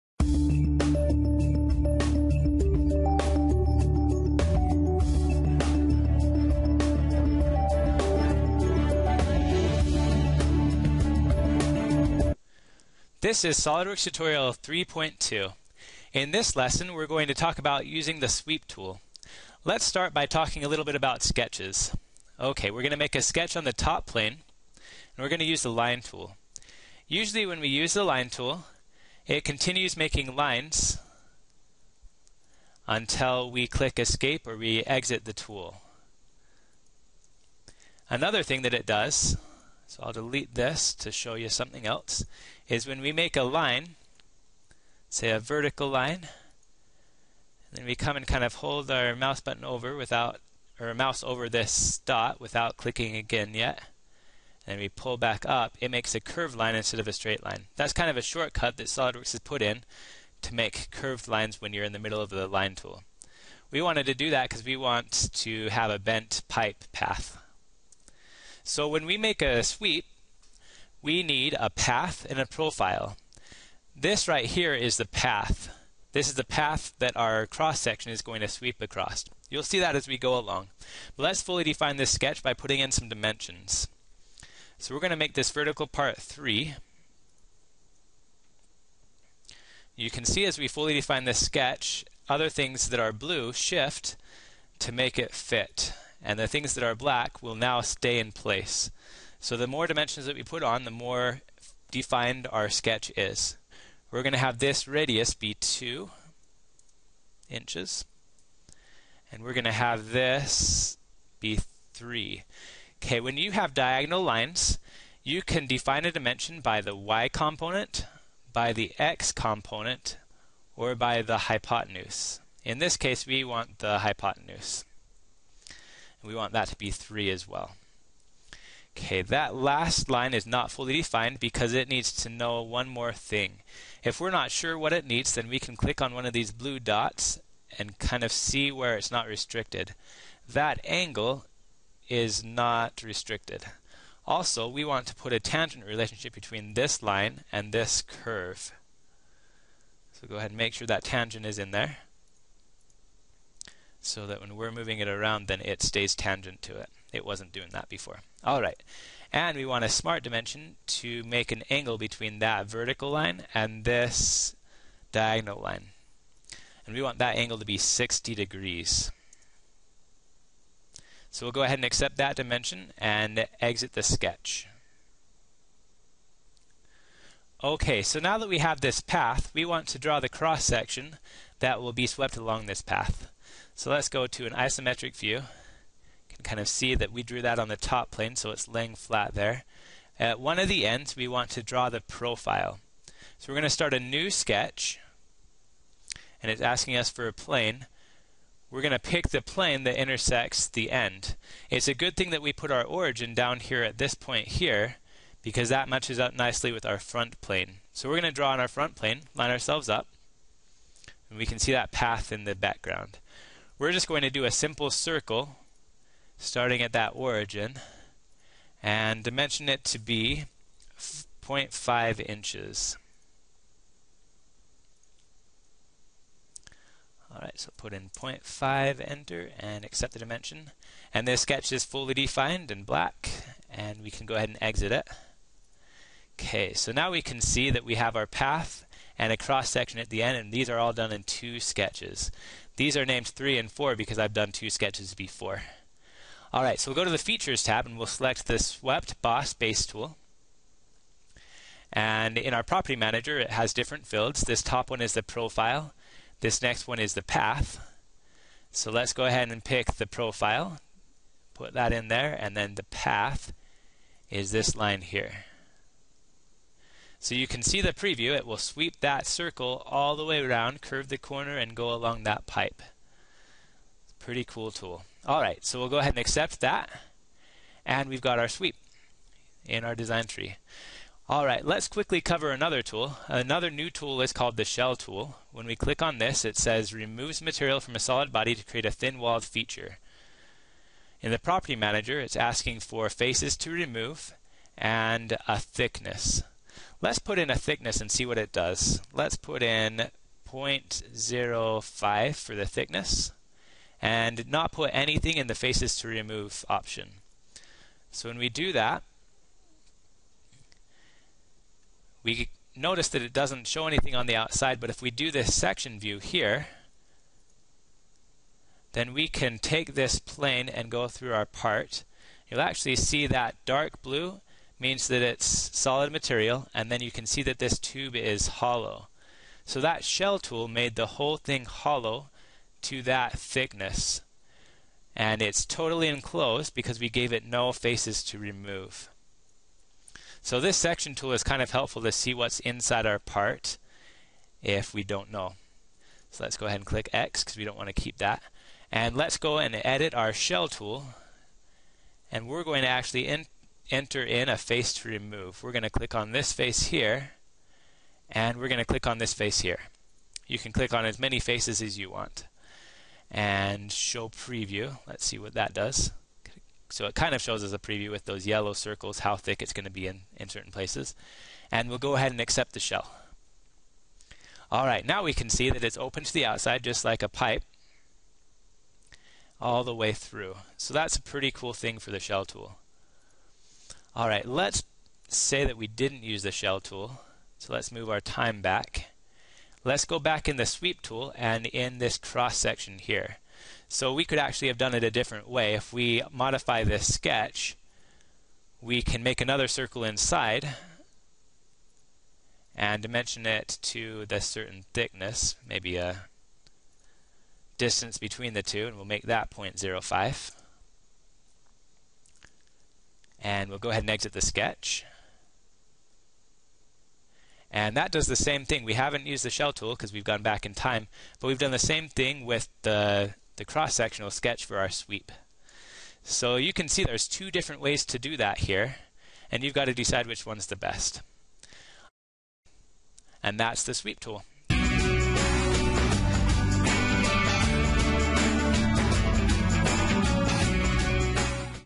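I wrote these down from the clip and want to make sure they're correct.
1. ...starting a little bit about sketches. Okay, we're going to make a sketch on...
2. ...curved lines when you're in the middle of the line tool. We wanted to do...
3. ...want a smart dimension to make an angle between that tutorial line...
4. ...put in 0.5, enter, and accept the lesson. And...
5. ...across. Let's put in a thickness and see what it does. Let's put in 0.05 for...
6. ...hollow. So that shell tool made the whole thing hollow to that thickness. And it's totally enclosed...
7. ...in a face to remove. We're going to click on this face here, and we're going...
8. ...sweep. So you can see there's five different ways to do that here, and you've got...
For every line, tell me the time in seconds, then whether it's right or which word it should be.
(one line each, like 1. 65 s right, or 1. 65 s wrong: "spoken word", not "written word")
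1. 20 s wrong: "talking", not "starting"
2. 60 s right
3. 159 s wrong: "vertical", not "tutorial"
4. 227 s wrong: "dimension", not "lesson"
5. 295 s wrong: "thickness", not "across"
6. 328 s right
7. 354 s right
8. 424 s wrong: "two", not "five".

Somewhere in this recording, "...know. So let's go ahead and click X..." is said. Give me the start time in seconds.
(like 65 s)
345 s.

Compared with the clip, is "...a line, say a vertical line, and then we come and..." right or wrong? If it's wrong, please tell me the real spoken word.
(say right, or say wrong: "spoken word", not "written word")
right.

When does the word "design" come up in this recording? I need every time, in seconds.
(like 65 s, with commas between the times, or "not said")
279 s.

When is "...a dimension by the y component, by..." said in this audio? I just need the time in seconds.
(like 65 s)
116 s.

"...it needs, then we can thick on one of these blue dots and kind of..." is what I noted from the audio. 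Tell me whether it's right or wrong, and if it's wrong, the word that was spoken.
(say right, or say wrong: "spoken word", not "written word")
wrong: "click", not "thick".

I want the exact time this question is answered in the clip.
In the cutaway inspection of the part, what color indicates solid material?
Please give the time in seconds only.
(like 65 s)
323 s.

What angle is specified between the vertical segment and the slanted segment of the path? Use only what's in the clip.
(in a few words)
60 degrees.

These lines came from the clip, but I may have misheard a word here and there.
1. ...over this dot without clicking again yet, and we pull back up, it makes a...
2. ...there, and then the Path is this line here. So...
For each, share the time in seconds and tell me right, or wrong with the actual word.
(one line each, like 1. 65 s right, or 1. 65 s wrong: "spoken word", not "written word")
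1. 51 s right
2. 262 s right.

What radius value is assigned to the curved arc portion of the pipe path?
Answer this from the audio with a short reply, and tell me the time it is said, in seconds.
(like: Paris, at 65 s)
2 inches, at 105 s.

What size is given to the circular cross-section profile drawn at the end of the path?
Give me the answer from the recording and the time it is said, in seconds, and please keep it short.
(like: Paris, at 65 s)
0.5 inches, at 220 s.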